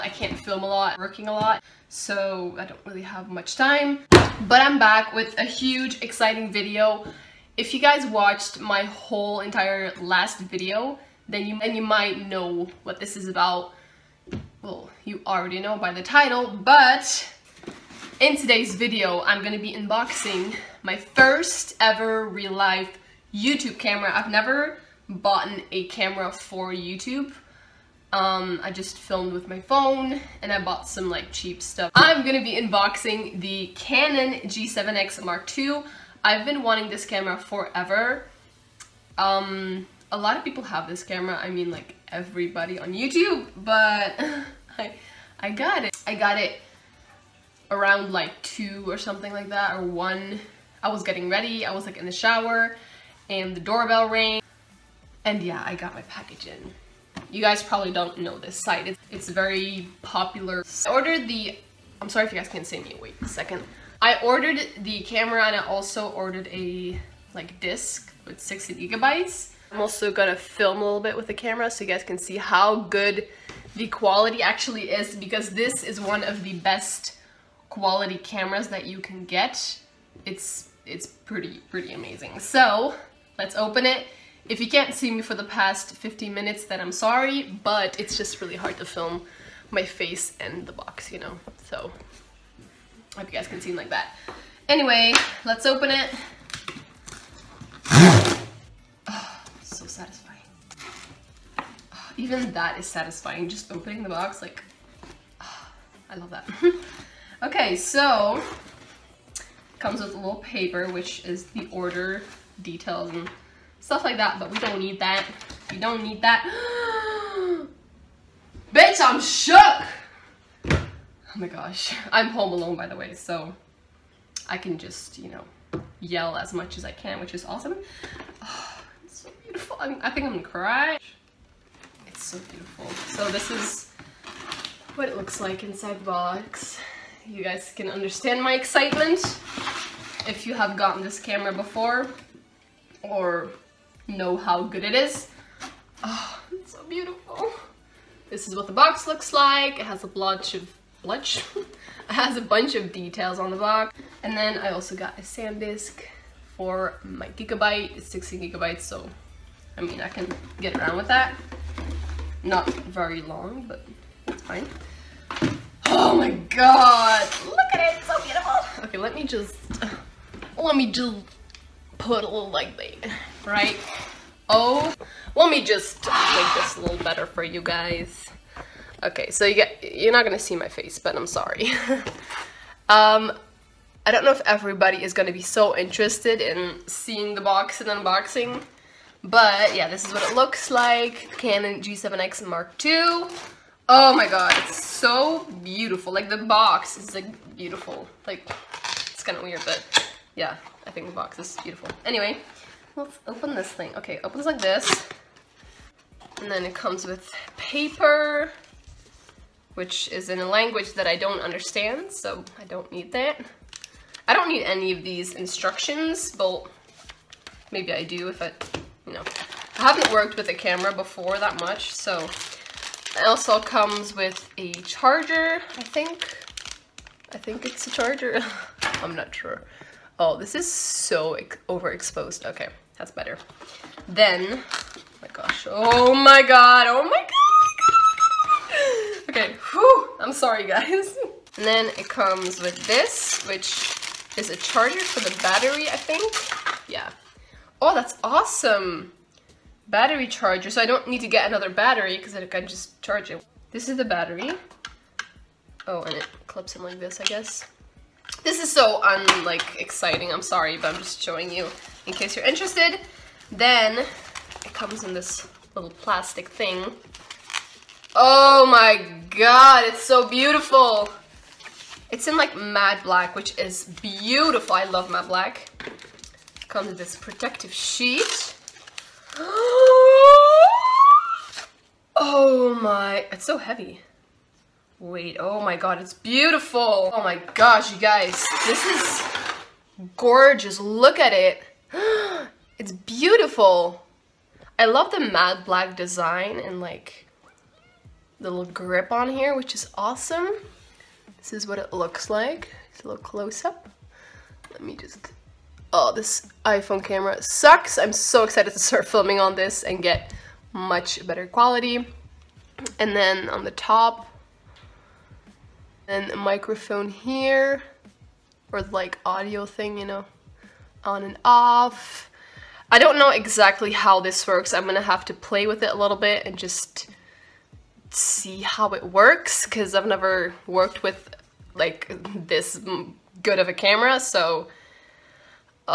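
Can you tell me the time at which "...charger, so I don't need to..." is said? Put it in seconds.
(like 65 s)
250 s.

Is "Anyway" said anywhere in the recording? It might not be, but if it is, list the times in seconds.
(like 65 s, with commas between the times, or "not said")
94 s, 202 s.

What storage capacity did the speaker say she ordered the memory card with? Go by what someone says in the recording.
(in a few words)
60 gigabytes.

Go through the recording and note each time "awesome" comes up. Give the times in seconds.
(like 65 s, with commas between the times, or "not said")
127 s, 248 s, 300 s.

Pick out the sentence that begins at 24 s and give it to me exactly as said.
I've never bought a camera for YouTube.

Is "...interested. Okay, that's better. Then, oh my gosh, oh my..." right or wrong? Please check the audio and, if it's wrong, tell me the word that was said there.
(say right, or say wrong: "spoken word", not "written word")
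wrong: "overexposed", not "interested".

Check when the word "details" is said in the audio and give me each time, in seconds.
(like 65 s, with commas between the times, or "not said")
112 s, 152 s.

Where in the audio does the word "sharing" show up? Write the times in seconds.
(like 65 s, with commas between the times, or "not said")
not said.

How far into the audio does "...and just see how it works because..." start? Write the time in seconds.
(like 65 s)
326 s.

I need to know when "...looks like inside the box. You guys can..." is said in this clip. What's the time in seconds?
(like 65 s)
135 s.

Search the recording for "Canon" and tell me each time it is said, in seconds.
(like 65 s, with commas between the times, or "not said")
33 s, 191 s.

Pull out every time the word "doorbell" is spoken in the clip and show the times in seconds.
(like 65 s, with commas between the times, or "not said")
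53 s.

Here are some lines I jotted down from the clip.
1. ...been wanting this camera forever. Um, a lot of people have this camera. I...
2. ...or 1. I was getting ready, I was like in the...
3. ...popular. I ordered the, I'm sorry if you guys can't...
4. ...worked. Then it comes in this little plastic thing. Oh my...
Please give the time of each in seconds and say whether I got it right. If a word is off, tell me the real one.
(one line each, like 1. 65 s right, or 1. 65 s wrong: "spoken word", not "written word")
1. 36 s right
2. 49 s right
3. 60 s right
4. 262 s wrong: "interested", not "worked".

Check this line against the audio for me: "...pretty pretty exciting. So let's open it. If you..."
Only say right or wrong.
wrong.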